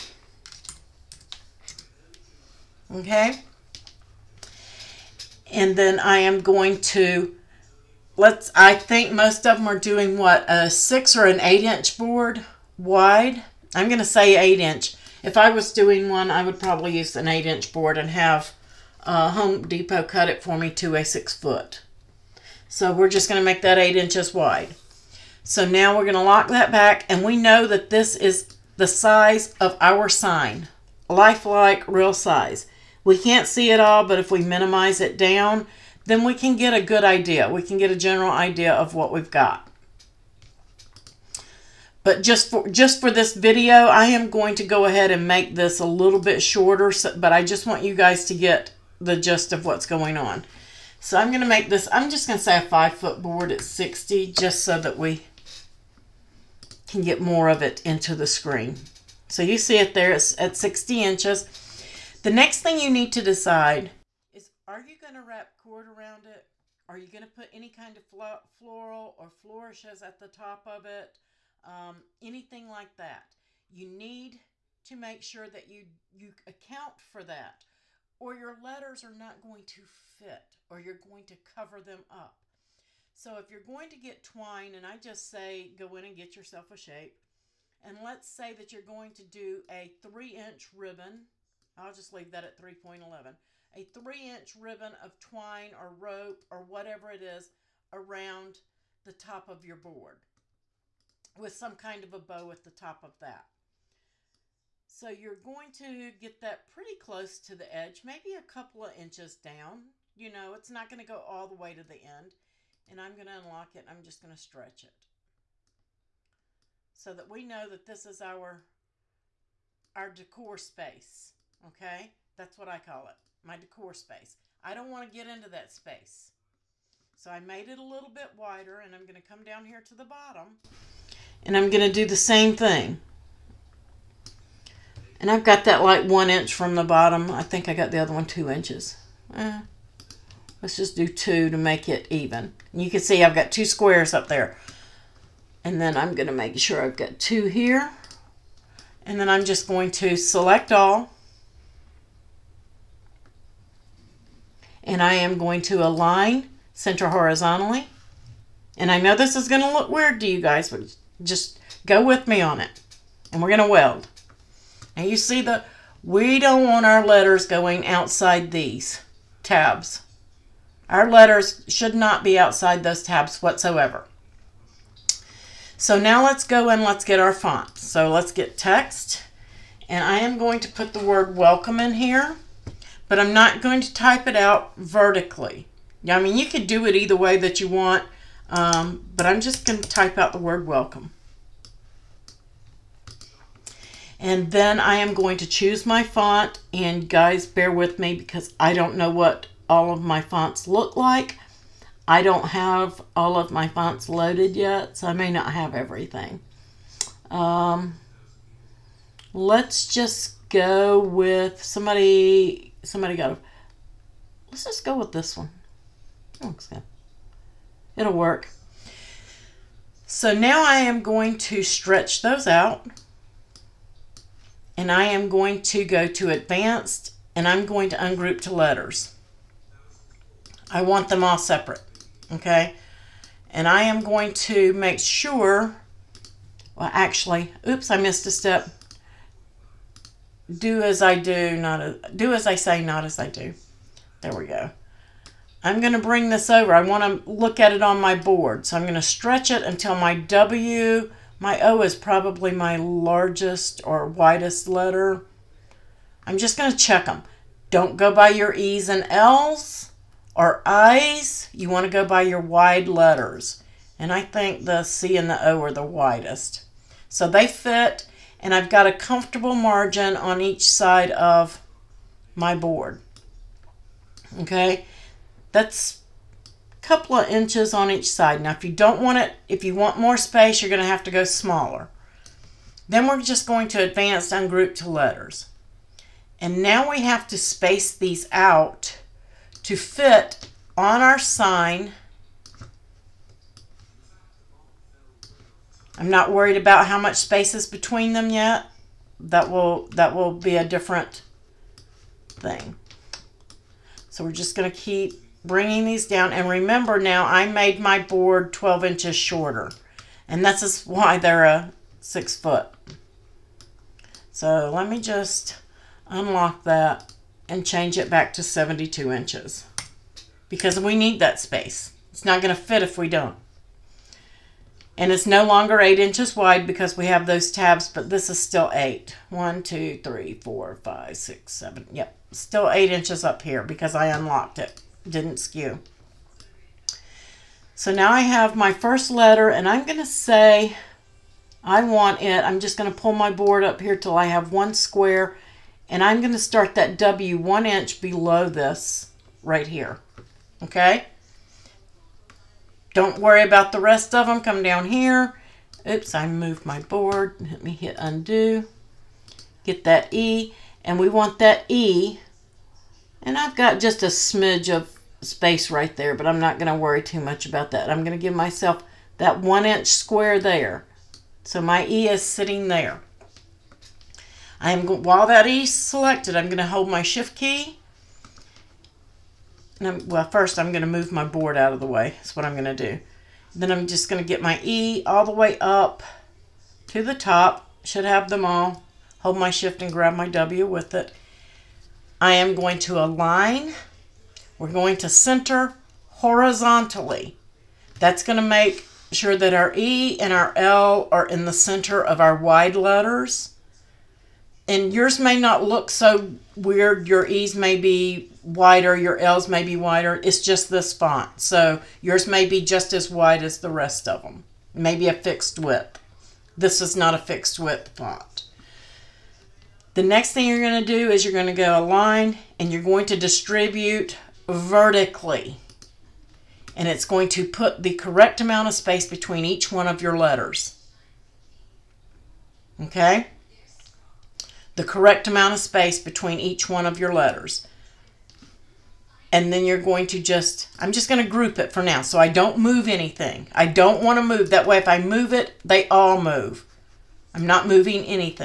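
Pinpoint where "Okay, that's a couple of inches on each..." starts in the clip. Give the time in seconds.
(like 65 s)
274 s.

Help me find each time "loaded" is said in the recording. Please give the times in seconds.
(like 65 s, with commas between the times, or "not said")
204 s.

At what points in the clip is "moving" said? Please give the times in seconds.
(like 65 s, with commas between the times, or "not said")
447 s.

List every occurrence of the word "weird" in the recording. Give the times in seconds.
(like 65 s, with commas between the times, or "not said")
159 s, 406 s.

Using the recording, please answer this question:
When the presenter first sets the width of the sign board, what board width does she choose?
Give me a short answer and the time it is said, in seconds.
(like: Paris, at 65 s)
8 inches, at 17 s.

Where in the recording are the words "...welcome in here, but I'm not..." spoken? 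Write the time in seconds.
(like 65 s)
181 s.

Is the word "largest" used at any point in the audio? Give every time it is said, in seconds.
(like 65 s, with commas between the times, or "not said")
252 s.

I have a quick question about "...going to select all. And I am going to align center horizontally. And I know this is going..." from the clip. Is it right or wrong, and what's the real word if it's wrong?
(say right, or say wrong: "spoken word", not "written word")
right.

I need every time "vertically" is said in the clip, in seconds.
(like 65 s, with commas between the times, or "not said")
184 s, 424 s.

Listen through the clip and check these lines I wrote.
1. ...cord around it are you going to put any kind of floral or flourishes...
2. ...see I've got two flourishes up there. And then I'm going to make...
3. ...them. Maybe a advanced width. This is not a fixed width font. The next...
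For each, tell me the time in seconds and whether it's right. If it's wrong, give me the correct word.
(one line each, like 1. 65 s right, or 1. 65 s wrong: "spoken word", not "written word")
1. 65 s right
2. 143 s wrong: "squares", not "flourishes"
3. 414 s wrong: "fixed", not "advanced".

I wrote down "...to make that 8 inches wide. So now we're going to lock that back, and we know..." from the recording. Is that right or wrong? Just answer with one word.
right.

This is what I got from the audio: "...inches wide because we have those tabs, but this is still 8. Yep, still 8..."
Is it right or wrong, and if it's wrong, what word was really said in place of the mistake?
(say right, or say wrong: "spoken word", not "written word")
right.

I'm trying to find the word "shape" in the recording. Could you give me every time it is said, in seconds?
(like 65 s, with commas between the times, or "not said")
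86 s.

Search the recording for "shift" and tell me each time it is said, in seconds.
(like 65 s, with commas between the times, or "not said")
377 s, 389 s.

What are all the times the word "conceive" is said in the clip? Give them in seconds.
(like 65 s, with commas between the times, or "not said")
not said.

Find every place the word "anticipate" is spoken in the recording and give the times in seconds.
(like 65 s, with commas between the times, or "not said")
not said.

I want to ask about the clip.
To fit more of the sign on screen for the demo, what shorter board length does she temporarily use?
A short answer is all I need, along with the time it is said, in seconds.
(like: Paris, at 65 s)
5 foot, at 52 s.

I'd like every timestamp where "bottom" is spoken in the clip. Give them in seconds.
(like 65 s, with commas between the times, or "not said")
130 s, 136 s.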